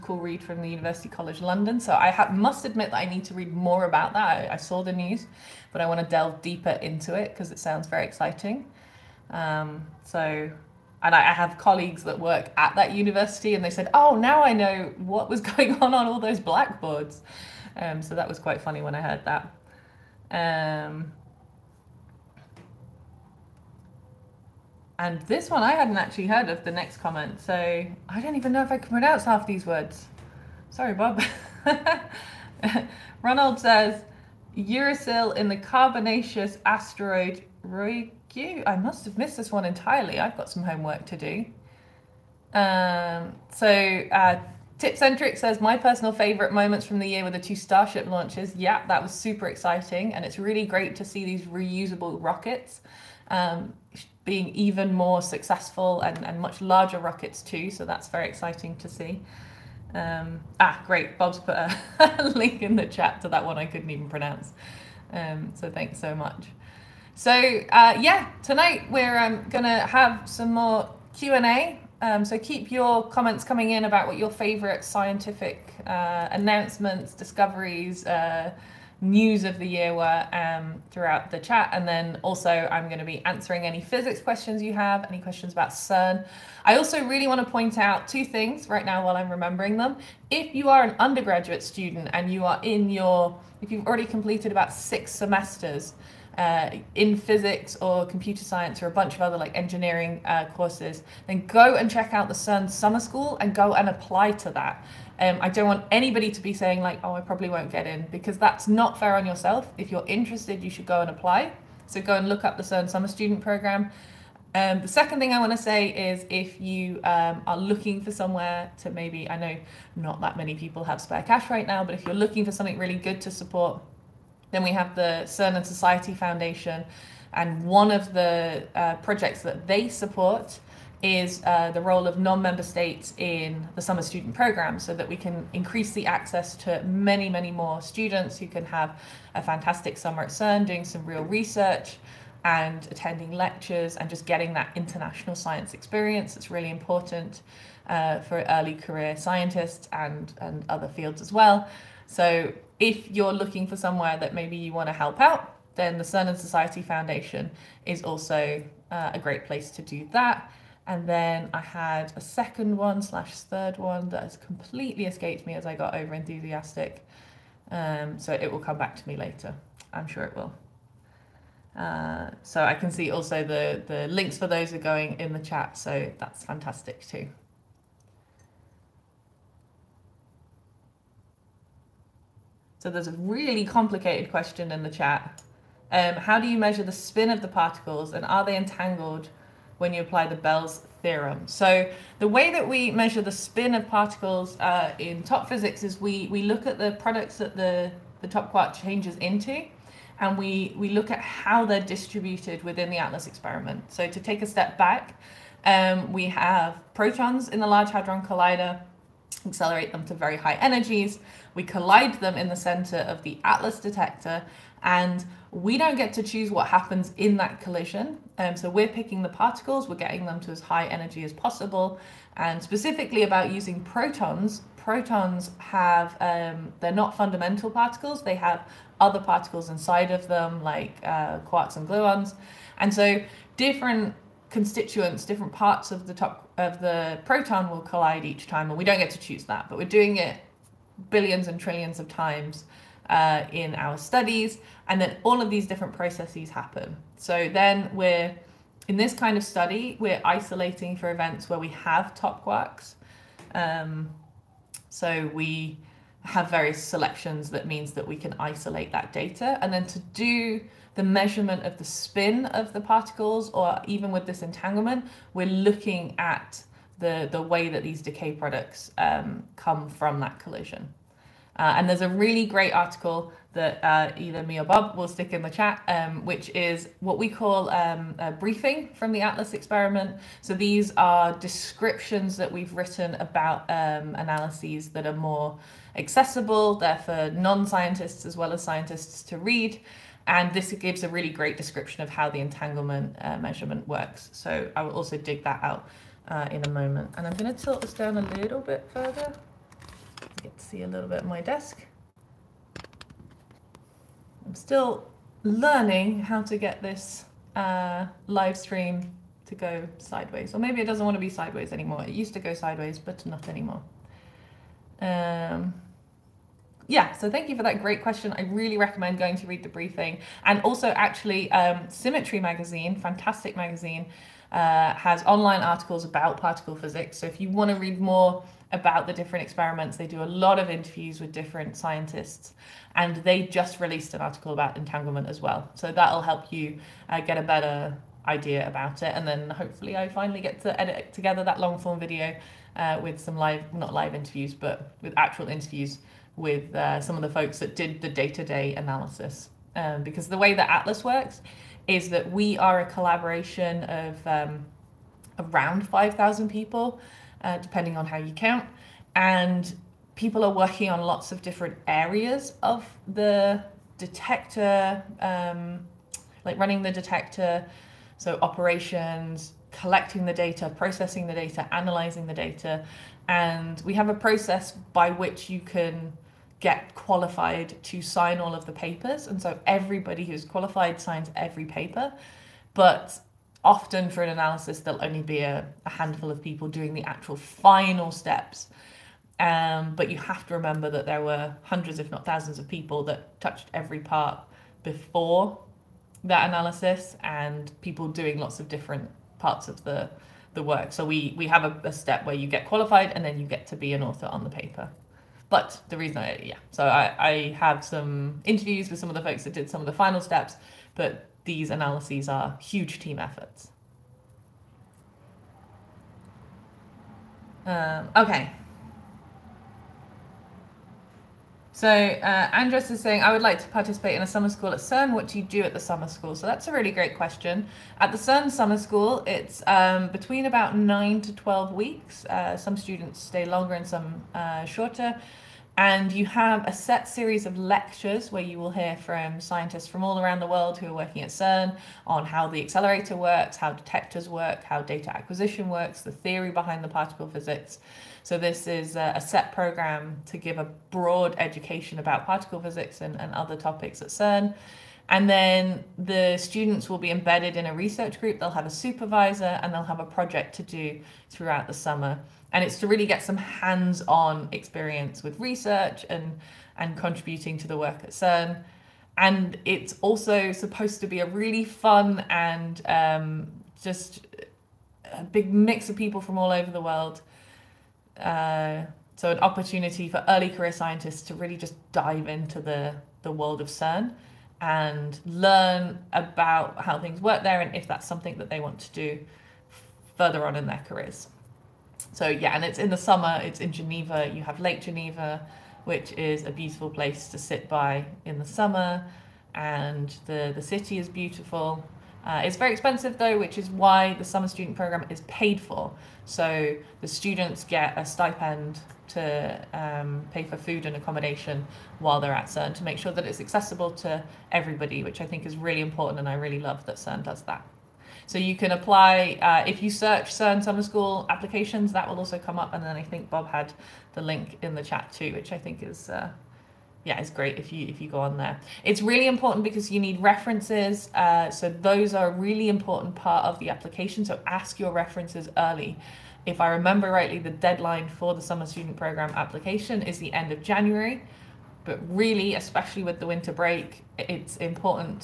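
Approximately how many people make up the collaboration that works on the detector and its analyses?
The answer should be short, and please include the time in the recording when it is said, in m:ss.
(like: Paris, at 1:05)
5,000, at 5:55.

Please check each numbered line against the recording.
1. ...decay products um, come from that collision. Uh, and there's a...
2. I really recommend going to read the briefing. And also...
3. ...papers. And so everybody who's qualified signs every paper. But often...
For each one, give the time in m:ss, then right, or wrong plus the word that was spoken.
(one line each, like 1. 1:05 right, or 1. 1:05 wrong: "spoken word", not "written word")
1. 4:28 right
2. 5:18 right
3. 6:18 right.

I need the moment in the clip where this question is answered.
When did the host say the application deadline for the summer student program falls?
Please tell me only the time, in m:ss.
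9:00.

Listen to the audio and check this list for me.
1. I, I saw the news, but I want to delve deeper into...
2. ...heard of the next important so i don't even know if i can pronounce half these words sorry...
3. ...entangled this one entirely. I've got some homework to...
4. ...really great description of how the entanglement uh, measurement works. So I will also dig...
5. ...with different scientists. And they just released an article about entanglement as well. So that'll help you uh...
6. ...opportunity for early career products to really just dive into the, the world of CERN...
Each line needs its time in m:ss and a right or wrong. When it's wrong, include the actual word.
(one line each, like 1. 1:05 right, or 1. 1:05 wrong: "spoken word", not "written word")
1. 0:04 right
2. 0:26 wrong: "comment", not "important"
3. 0:39 wrong: "missed", not "entangled"
4. 4:51 right
5. 5:31 right
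6. 7:59 wrong: "scientists", not "products".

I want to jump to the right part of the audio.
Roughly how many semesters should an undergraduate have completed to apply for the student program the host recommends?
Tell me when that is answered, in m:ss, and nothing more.
1:34.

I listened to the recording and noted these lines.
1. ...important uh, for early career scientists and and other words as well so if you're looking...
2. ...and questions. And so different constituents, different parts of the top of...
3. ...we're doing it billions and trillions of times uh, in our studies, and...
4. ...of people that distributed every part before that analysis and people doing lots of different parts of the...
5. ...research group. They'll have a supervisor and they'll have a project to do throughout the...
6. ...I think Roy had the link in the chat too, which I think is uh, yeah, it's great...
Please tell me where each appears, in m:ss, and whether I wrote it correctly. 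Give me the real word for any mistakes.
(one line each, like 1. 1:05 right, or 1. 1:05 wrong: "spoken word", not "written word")
1. 2:26 wrong: "fields", not "words"
2. 3:51 wrong: "gluons", not "questions"
3. 3:59 right
4. 6:32 wrong: "touched", not "distributed"
5. 7:37 right
6. 8:42 wrong: "Bob", not "Roy".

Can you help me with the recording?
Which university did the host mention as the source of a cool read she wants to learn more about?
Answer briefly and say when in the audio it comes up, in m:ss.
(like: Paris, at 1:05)
University College London, at 0:00.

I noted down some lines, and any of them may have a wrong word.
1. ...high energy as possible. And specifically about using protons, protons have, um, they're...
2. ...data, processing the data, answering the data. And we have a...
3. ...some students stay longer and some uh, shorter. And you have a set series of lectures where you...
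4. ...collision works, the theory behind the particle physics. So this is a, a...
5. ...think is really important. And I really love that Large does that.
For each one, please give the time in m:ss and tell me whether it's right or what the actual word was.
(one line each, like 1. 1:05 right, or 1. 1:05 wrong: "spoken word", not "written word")
1. 3:40 right
2. 6:10 wrong: "analyzing", not "answering"
3. 7:12 right
4. 7:25 wrong: "acquisition", not "collision"
5. 8:35 wrong: "CERN", not "Large".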